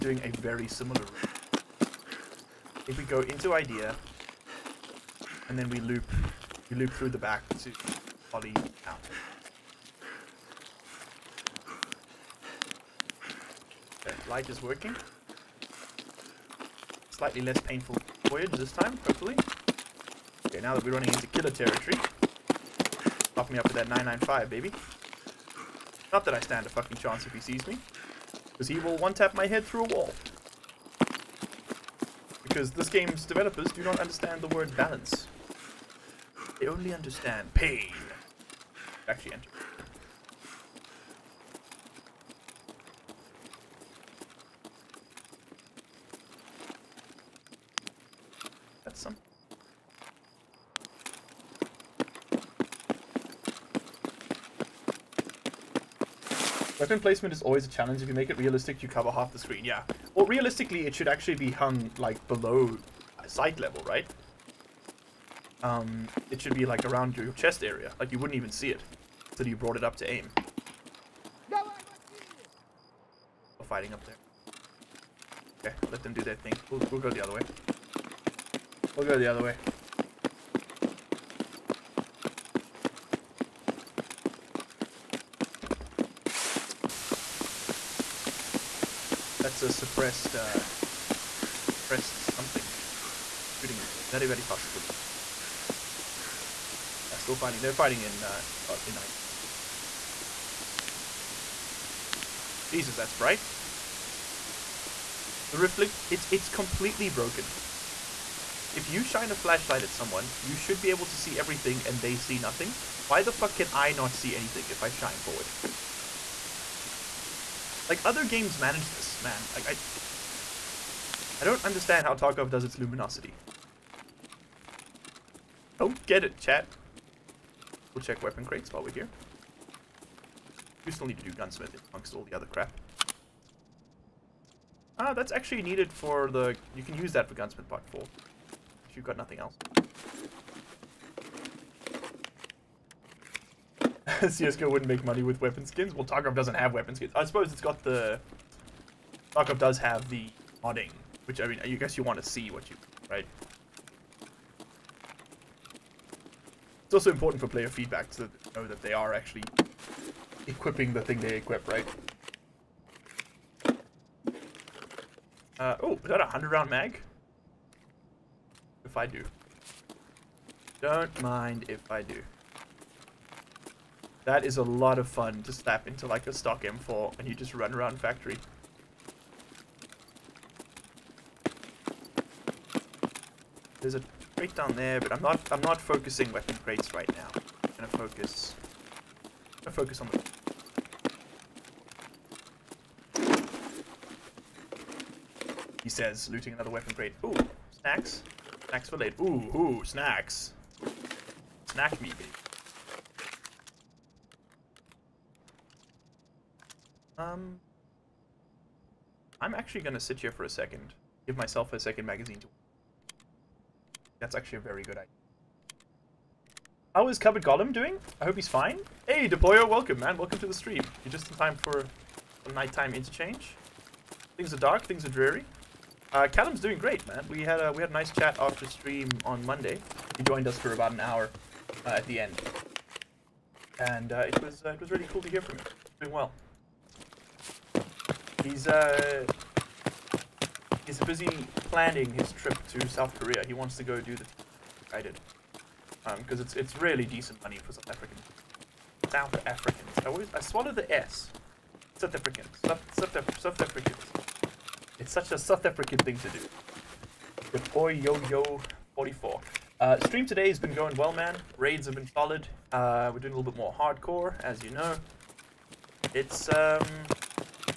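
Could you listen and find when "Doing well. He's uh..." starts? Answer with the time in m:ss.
3:56.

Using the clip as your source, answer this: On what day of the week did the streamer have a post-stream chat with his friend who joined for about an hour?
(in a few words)
Monday.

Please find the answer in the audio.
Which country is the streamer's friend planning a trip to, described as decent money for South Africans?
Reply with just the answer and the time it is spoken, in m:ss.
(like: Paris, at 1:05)
South Korea, at 4:02.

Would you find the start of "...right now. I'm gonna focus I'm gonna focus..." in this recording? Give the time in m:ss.
3:06.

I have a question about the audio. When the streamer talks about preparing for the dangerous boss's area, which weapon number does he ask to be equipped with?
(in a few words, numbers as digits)
995.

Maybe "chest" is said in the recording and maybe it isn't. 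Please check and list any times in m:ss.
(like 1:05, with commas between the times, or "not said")
1:07.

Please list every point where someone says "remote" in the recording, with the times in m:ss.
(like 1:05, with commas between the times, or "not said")
not said.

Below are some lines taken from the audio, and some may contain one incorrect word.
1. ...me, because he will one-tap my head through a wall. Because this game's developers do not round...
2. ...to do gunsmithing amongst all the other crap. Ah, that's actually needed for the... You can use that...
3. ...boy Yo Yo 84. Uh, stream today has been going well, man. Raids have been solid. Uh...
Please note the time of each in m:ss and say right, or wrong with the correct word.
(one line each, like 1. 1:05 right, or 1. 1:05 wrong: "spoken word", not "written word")
1. 0:27 wrong: "understand", not "round"
2. 2:11 right
3. 4:17 wrong: "44", not "84".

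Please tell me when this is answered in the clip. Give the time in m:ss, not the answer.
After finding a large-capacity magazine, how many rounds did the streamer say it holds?
2:46.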